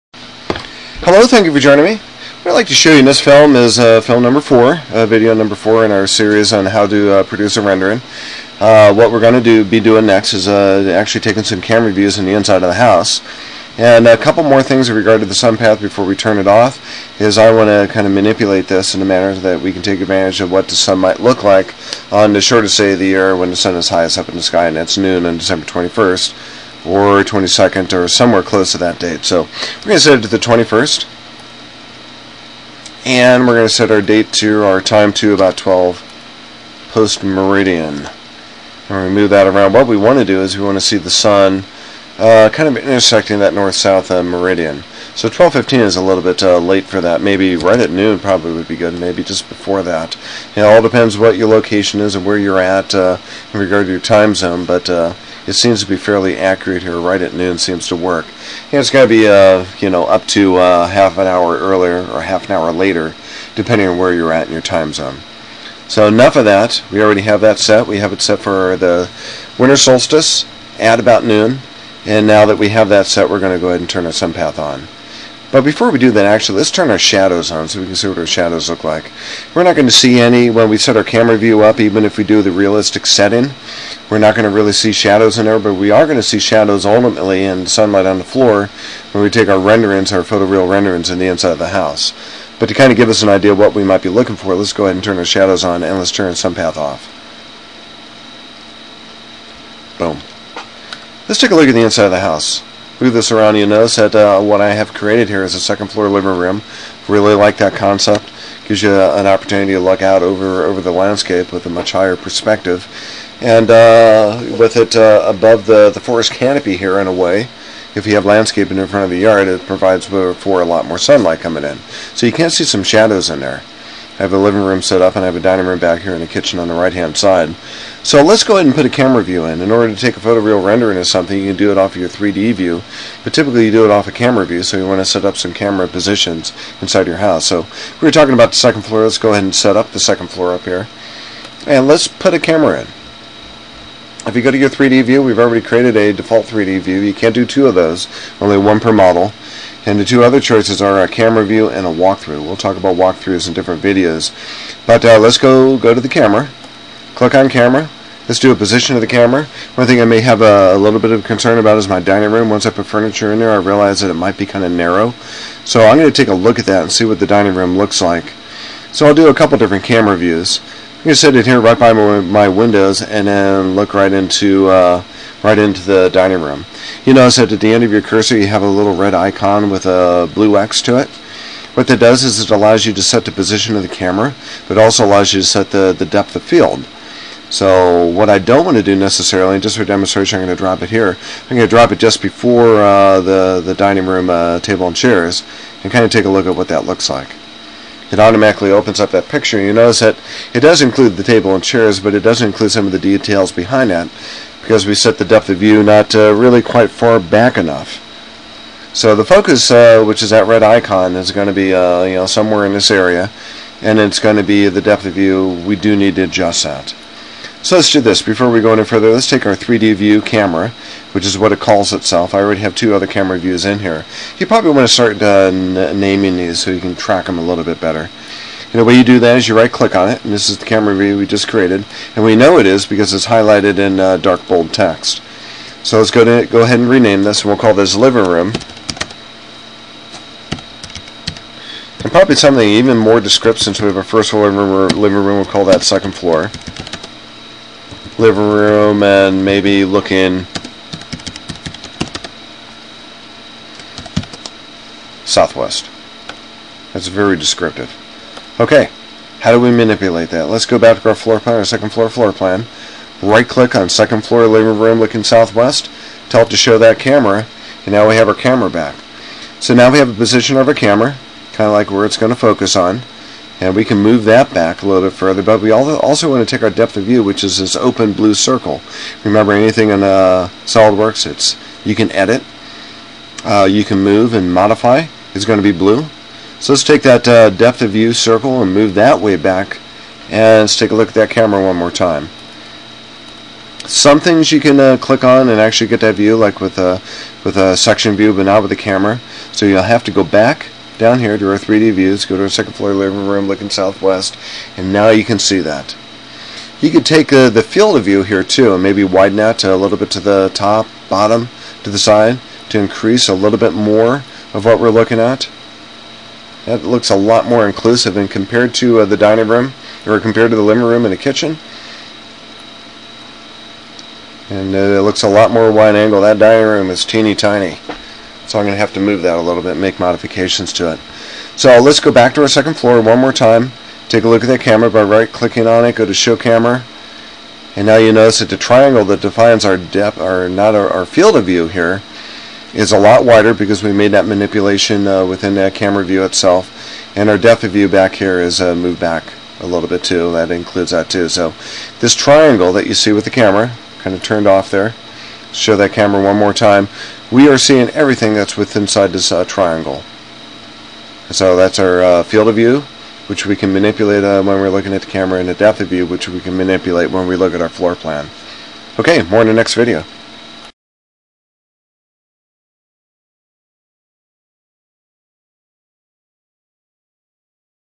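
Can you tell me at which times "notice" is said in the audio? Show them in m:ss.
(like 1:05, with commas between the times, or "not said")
1:43, 2:57, 3:19, 5:38.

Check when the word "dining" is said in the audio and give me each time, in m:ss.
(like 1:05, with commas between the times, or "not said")
2:05, 2:41, 2:47, 2:56, 3:13, 5:19, 5:26.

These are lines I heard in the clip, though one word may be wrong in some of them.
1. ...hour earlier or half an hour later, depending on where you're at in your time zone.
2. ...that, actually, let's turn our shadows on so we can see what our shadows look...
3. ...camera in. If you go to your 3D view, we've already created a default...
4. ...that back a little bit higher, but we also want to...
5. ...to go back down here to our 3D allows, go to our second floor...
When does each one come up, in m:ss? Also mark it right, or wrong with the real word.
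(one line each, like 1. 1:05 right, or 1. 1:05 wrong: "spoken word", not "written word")
1. 1:01 right
2. 1:16 right
3. 2:22 right
4. 4:34 wrong: "further", not "higher"
5. 5:00 wrong: "views", not "allows".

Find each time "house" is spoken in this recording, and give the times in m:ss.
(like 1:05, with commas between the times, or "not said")
0:12, 1:31, 1:42, 2:17.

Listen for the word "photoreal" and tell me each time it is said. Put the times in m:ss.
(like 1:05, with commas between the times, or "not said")
1:30, 2:10.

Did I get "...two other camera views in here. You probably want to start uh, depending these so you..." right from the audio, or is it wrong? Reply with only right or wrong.
wrong.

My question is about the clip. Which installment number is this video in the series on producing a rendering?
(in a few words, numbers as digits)
4.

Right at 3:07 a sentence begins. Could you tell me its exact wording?
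So what I don't want to do necessarily, just for demonstration, I'm going to drop it here.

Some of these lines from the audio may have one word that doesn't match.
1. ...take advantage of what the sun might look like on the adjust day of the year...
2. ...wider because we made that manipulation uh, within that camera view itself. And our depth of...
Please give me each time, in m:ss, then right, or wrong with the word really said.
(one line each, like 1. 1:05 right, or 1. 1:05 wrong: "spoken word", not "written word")
1. 0:19 wrong: "shortest", not "adjust"
2. 5:43 right.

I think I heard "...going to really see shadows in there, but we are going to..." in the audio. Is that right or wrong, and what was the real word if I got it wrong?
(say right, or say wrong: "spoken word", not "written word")
right.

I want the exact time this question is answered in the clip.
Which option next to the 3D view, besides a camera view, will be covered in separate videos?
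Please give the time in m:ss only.
2:31.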